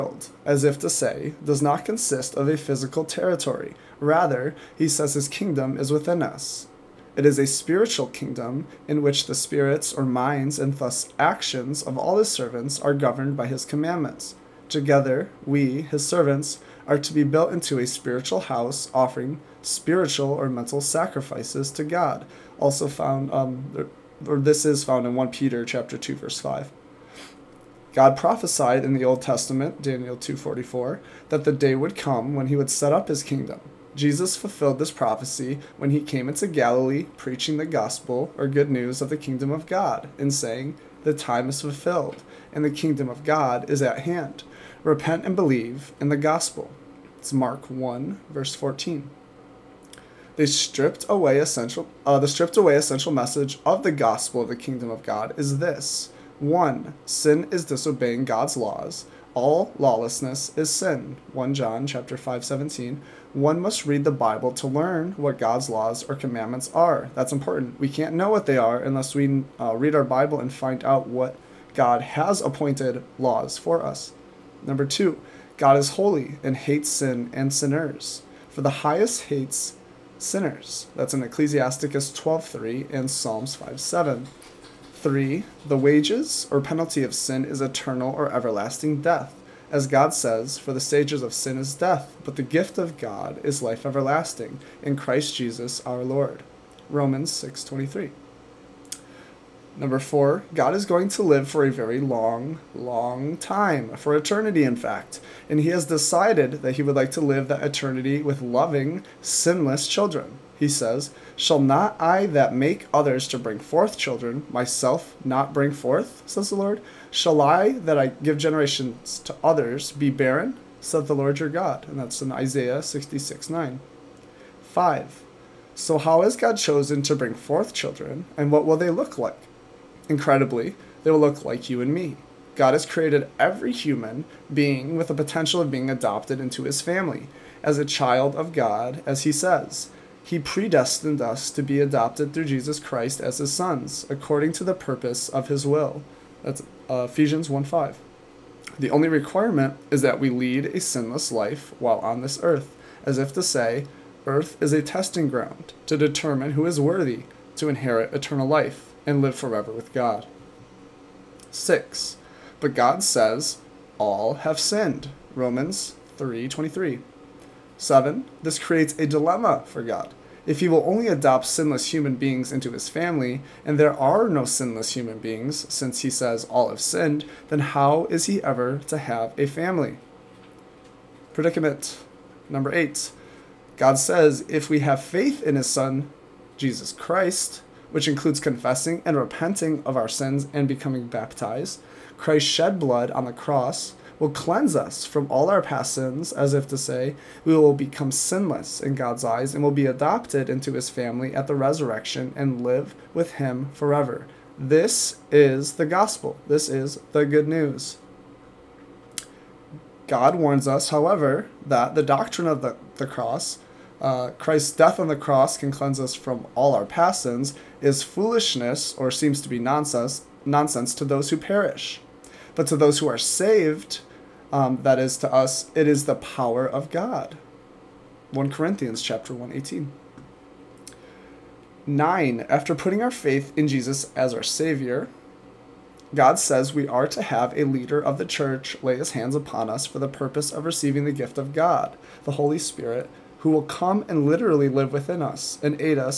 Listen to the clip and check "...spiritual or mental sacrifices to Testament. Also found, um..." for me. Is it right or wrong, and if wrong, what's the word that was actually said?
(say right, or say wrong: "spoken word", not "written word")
wrong: "God", not "Testament".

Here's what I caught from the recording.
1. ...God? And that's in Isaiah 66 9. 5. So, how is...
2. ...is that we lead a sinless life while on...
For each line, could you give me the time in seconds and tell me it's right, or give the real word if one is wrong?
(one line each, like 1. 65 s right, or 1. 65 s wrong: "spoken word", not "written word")
1. 121 s right
2. 149 s right.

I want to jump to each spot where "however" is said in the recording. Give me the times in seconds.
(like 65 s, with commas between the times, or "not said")
210 s.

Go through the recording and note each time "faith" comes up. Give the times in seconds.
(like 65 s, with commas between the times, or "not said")
185 s, 233 s.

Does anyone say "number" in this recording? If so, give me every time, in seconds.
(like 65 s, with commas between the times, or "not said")
74 s, 99 s, 182 s.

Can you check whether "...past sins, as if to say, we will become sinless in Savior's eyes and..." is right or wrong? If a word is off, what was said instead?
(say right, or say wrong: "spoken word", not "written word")
wrong: "God", not "Savior".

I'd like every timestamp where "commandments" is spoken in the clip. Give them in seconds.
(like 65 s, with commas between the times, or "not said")
13 s, 66 s.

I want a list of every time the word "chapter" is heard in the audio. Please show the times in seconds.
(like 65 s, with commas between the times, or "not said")
25 s, 61 s, 229 s.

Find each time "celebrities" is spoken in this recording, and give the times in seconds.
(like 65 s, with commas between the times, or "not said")
not said.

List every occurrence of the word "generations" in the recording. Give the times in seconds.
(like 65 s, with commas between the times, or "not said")
118 s.